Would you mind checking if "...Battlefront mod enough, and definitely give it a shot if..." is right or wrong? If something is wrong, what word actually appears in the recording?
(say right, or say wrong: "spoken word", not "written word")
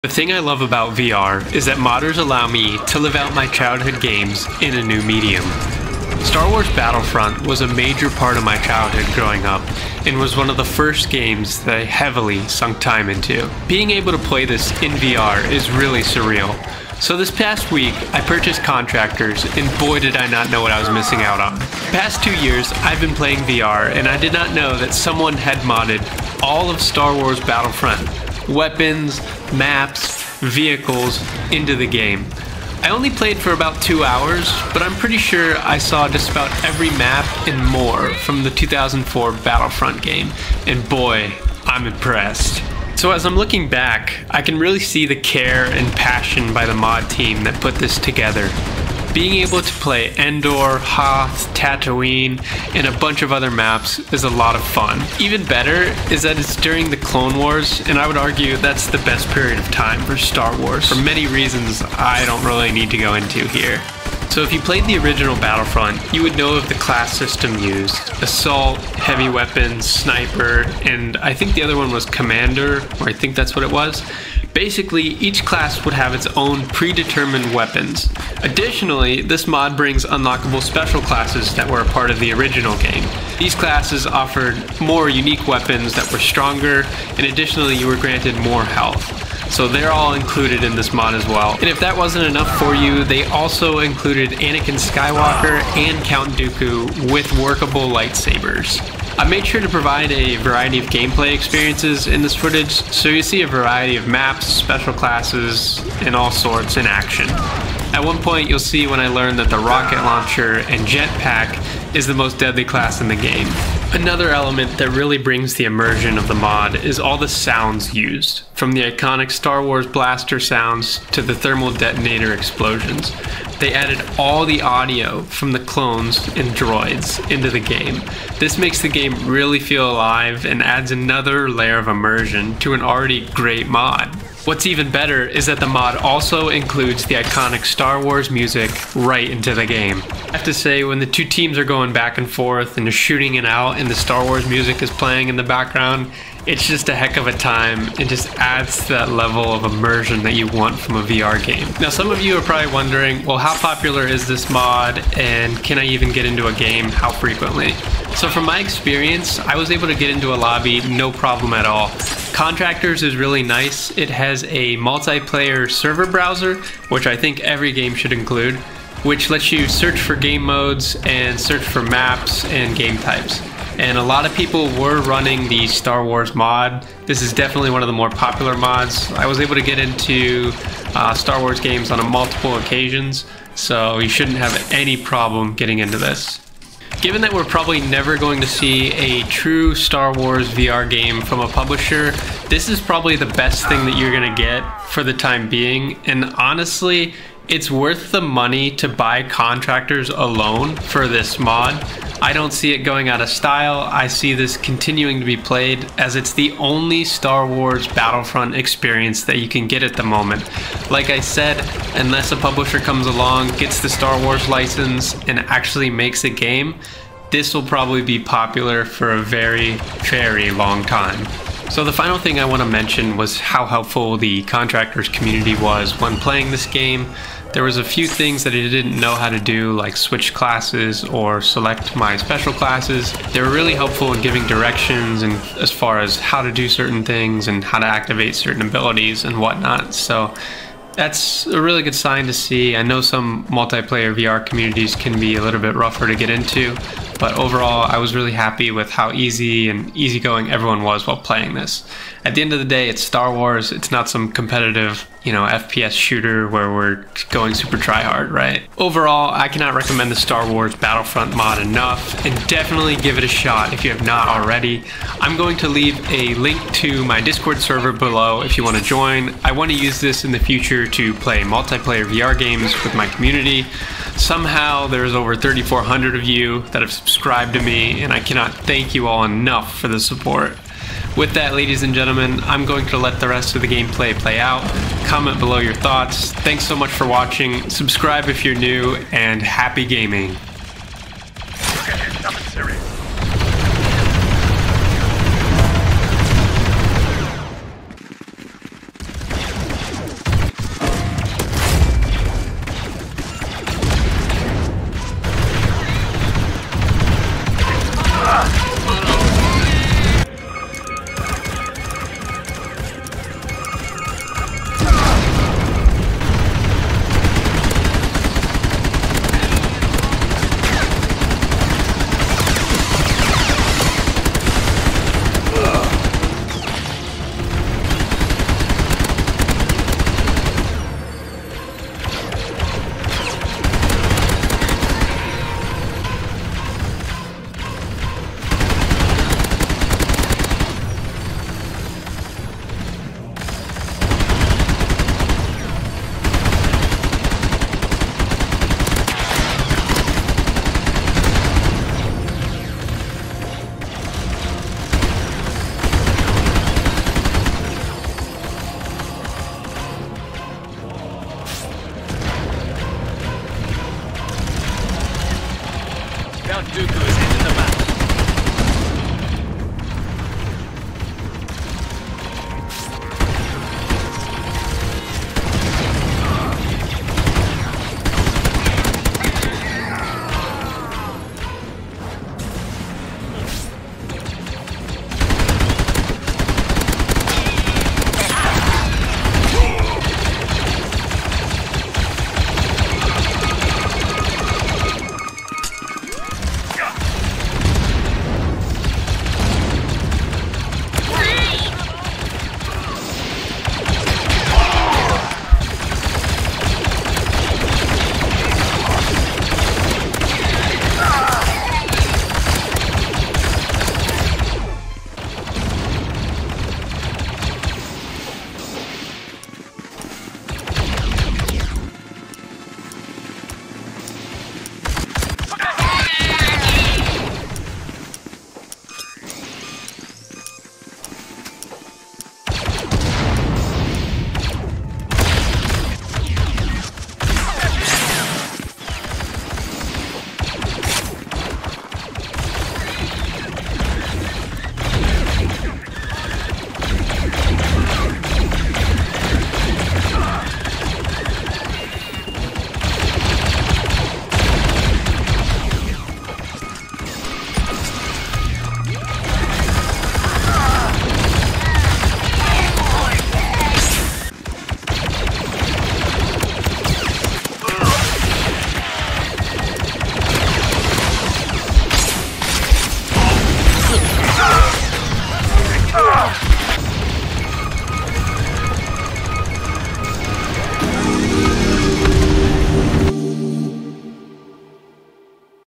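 right.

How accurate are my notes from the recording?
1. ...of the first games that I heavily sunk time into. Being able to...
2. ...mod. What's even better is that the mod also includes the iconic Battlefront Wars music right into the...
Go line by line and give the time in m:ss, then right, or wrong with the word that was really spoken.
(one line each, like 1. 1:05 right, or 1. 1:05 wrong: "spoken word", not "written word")
1. 0:10 right
2. 2:13 wrong: "Star", not "Battlefront".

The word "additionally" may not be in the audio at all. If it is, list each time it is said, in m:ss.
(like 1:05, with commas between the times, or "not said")
1:18, 1:27.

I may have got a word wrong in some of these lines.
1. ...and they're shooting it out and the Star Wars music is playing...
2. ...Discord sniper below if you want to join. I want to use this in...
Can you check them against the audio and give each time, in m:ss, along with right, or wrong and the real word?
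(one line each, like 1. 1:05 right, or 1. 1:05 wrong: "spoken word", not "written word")
1. 2:22 right
2. 4:27 wrong: "server", not "sniper".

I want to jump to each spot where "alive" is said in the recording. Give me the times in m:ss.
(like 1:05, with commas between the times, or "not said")
2:09.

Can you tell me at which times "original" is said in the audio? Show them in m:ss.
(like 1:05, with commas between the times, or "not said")
1:04, 1:22.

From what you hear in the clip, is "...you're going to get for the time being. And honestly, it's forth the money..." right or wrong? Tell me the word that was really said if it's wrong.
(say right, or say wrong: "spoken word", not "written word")
wrong: "worth", not "forth".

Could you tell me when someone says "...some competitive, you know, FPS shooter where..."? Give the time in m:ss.
4:14.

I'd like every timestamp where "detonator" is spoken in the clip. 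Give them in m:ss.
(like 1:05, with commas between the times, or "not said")
2:01.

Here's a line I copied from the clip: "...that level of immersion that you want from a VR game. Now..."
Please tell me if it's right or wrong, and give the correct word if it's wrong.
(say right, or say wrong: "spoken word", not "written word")
right.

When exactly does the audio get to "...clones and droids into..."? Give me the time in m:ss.
2:05.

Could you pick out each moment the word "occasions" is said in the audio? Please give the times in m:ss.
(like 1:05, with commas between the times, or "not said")
3:02.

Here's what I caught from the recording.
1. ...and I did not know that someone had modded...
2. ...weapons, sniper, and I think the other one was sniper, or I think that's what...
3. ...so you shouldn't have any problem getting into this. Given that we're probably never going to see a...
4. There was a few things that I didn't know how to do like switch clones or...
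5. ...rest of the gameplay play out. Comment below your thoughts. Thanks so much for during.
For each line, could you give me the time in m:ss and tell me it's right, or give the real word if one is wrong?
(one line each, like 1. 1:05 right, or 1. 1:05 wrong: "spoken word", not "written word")
1. 0:23 right
2. 1:09 wrong: "commander", not "sniper"
3. 3:03 right
4. 3:47 wrong: "classes", not "clones"
5. 4:43 wrong: "watching", not "during".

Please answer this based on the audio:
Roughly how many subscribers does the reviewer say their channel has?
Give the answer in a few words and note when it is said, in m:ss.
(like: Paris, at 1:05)
over 3,400, at 4:35.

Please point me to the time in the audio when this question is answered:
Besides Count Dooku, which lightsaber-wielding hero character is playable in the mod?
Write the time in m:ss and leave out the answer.
1:34.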